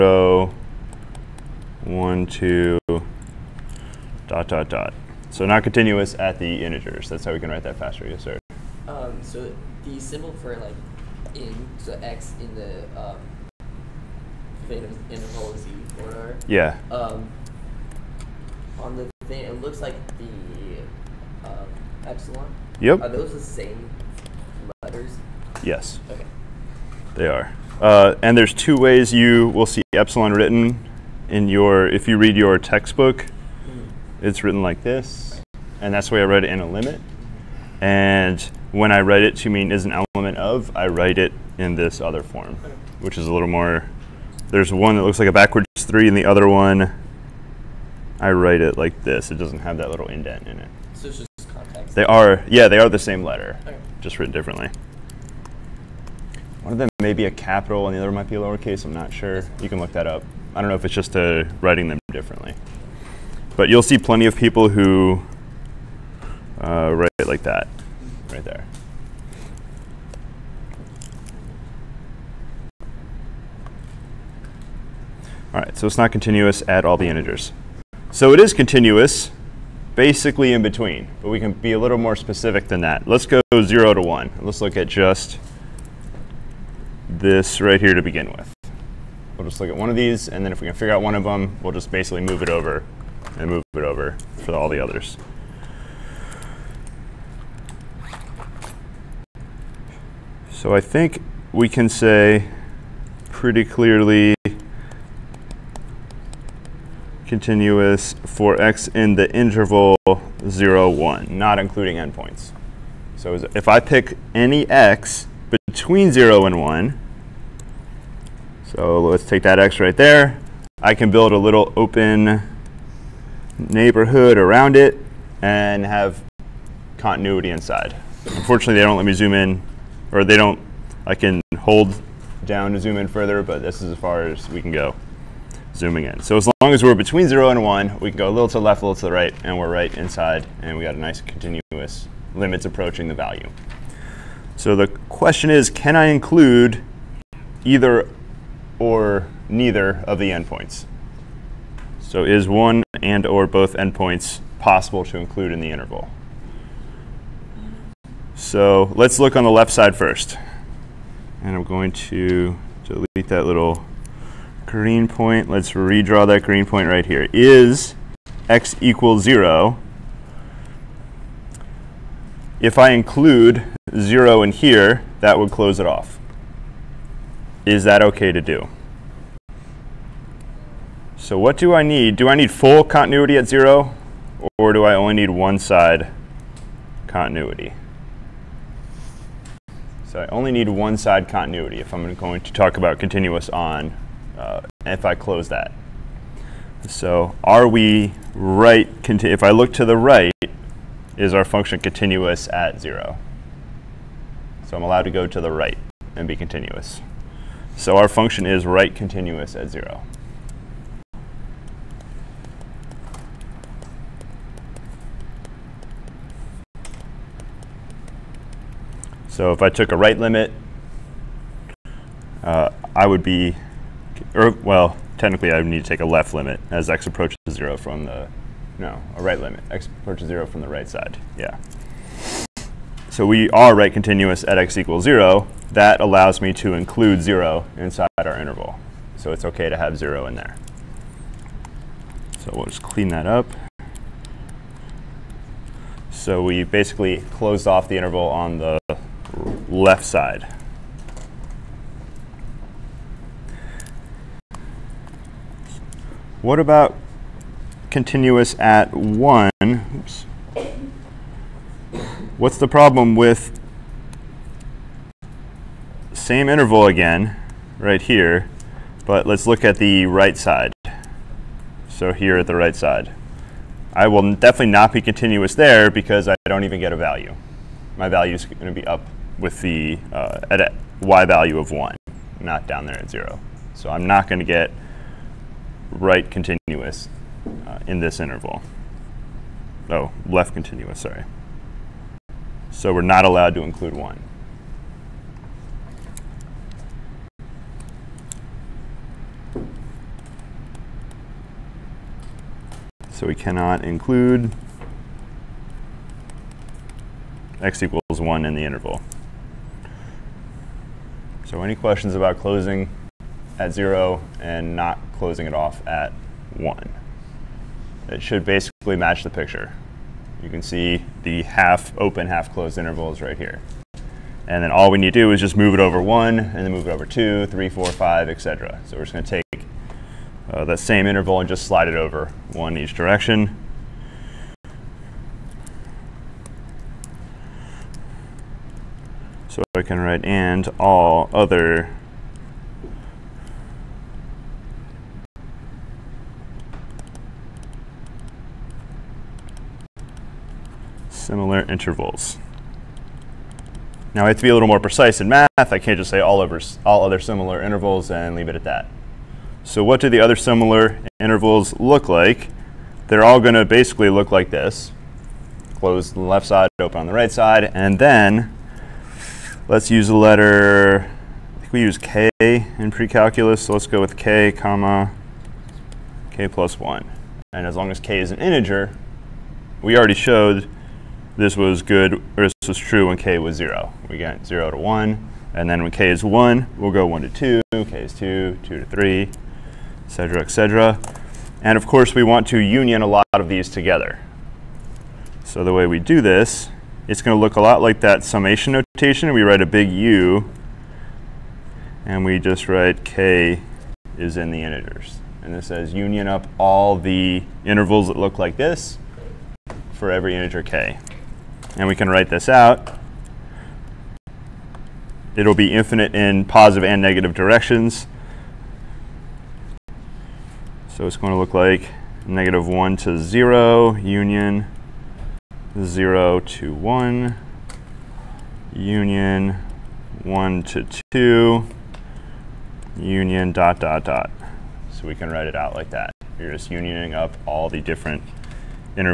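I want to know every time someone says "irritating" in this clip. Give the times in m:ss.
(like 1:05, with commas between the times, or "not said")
not said.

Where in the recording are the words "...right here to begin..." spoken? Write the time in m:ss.
1:27.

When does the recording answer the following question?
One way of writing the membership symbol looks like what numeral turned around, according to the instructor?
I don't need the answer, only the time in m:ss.
0:45.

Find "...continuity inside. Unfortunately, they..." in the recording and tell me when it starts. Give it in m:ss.
2:06.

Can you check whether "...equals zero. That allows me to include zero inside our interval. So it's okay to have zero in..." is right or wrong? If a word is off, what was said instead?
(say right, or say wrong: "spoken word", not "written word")
right.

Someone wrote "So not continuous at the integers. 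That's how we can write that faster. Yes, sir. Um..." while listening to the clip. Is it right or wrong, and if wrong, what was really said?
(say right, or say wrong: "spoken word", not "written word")
right.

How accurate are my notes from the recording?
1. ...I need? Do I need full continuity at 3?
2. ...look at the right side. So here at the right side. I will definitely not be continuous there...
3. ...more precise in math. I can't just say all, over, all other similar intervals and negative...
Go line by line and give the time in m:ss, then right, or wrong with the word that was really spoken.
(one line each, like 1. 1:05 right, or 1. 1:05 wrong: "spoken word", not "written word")
1. 3:01 wrong: "0", not "3"
2. 4:29 right
3. 5:54 wrong: "leave", not "negative".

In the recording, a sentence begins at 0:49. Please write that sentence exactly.
It doesn't have that little indent in it.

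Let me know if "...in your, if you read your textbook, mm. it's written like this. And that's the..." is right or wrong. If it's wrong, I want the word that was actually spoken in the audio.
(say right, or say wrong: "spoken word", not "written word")
right.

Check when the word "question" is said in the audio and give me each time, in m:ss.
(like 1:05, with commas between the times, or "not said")
2:25, 5:11.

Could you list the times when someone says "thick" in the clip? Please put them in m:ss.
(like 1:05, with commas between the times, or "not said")
not said.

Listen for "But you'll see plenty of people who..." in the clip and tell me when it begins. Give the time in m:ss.
1:03.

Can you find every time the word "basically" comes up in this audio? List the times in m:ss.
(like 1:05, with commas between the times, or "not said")
1:19, 1:31, 4:06, 5:18, 6:03.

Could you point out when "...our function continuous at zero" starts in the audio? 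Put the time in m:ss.
3:21.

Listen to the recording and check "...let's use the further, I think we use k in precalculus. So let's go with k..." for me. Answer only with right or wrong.
wrong.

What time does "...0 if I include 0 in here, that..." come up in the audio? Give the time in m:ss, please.
2:49.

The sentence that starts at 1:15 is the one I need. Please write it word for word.
All right, so it's not continuous at all the integers.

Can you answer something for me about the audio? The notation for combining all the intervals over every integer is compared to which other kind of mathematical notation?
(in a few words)
summation notation.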